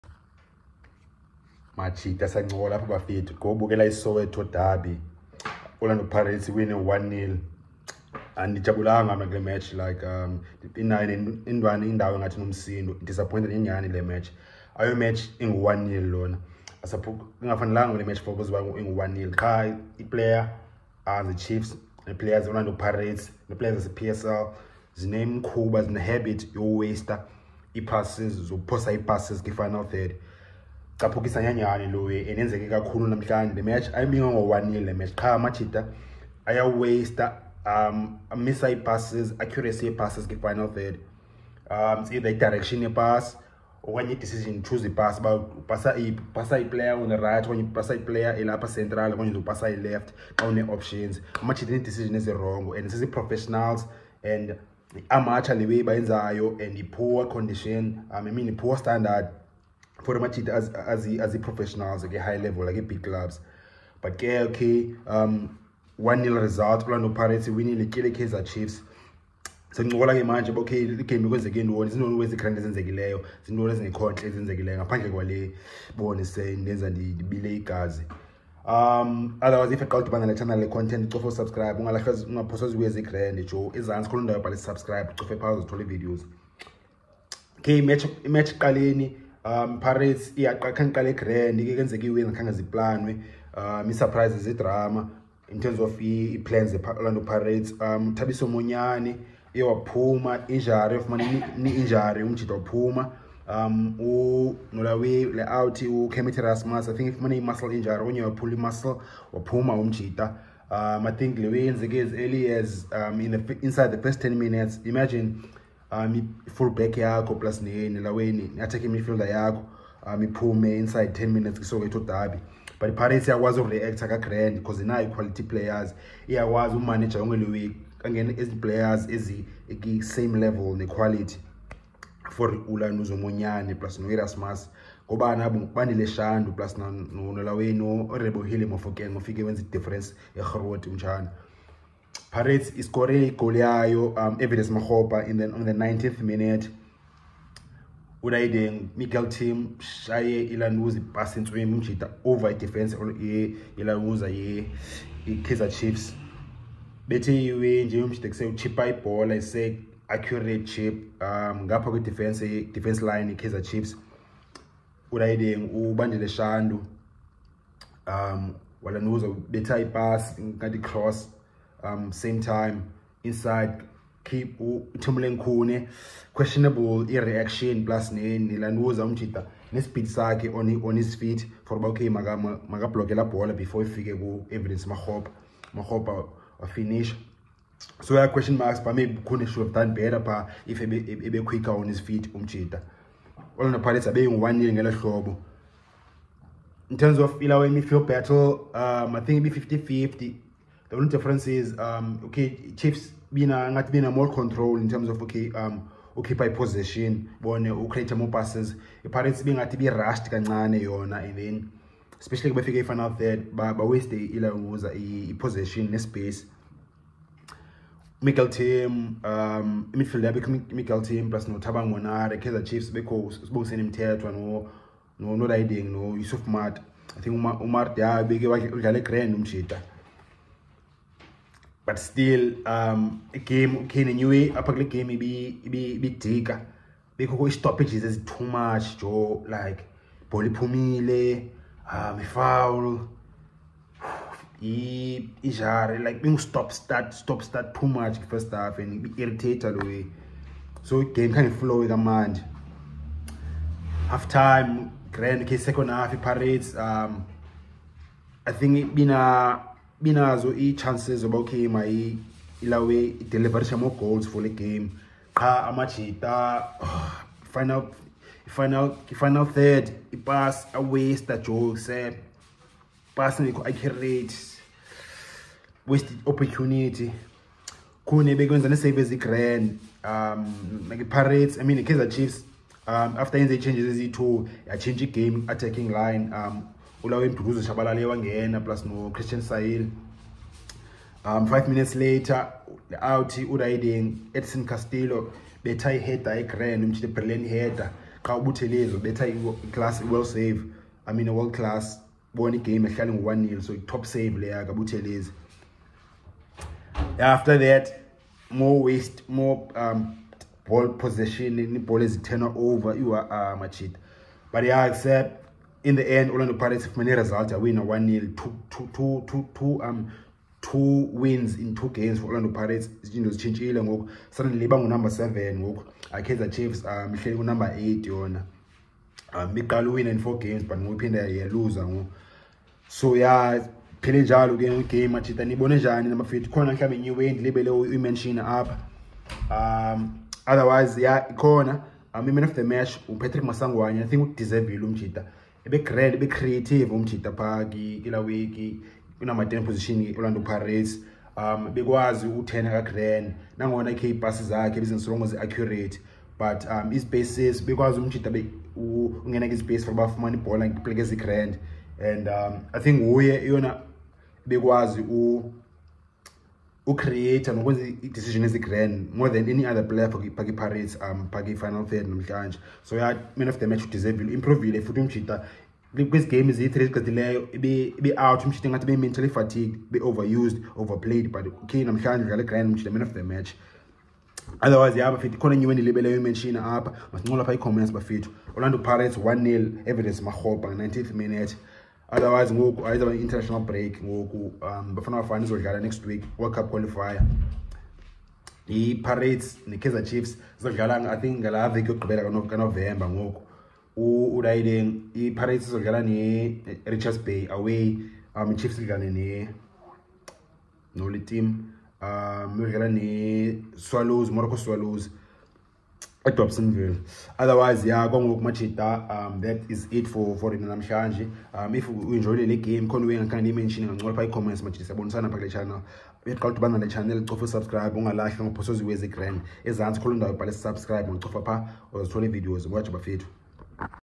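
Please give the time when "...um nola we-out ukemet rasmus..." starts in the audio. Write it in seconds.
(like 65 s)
103 s.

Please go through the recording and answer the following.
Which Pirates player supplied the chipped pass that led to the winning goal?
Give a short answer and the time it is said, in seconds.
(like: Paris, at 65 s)
Miguel Timm, at 148 s.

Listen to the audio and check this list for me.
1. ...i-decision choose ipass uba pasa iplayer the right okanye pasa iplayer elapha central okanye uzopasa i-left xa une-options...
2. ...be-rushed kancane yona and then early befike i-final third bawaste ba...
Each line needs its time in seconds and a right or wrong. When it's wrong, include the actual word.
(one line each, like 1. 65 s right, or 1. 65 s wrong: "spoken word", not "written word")
1. 44 s right
2. 209 s wrong: "especially", not "early".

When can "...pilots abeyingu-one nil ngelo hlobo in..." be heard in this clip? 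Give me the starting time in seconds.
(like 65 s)
193 s.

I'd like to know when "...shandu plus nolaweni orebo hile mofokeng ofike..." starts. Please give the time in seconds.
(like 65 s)
136 s.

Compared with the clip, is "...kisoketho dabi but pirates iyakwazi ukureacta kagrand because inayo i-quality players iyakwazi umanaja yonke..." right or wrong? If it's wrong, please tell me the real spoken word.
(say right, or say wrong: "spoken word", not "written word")
right.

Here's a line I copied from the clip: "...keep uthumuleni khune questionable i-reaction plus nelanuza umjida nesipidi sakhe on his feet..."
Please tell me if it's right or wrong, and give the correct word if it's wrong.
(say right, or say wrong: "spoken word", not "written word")
right.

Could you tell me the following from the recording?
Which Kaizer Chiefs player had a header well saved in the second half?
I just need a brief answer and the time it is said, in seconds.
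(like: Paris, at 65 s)
Edson Castillo, at 294 s.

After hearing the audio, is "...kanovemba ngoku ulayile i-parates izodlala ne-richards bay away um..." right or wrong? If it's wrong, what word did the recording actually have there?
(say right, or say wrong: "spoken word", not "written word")
right.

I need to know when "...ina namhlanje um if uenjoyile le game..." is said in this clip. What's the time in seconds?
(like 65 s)
420 s.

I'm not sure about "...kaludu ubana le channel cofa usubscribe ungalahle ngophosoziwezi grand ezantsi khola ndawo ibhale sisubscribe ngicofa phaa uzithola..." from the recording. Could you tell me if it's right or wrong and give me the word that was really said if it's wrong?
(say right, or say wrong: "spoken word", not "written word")
right.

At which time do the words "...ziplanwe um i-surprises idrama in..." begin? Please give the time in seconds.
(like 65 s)
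92 s.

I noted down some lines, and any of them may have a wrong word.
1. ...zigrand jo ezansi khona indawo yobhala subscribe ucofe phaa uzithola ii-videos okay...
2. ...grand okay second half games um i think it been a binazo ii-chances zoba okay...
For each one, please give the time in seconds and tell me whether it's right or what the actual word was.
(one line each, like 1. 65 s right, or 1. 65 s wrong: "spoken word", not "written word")
1. 82 s right
2. 255 s wrong: "parades", not "games".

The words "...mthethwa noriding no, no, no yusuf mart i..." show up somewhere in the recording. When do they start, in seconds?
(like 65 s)
223 s.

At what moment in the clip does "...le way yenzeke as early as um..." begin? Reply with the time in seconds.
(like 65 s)
111 s.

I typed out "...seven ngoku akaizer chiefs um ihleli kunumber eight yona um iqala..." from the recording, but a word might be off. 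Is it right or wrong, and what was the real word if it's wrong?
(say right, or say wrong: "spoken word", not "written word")
right.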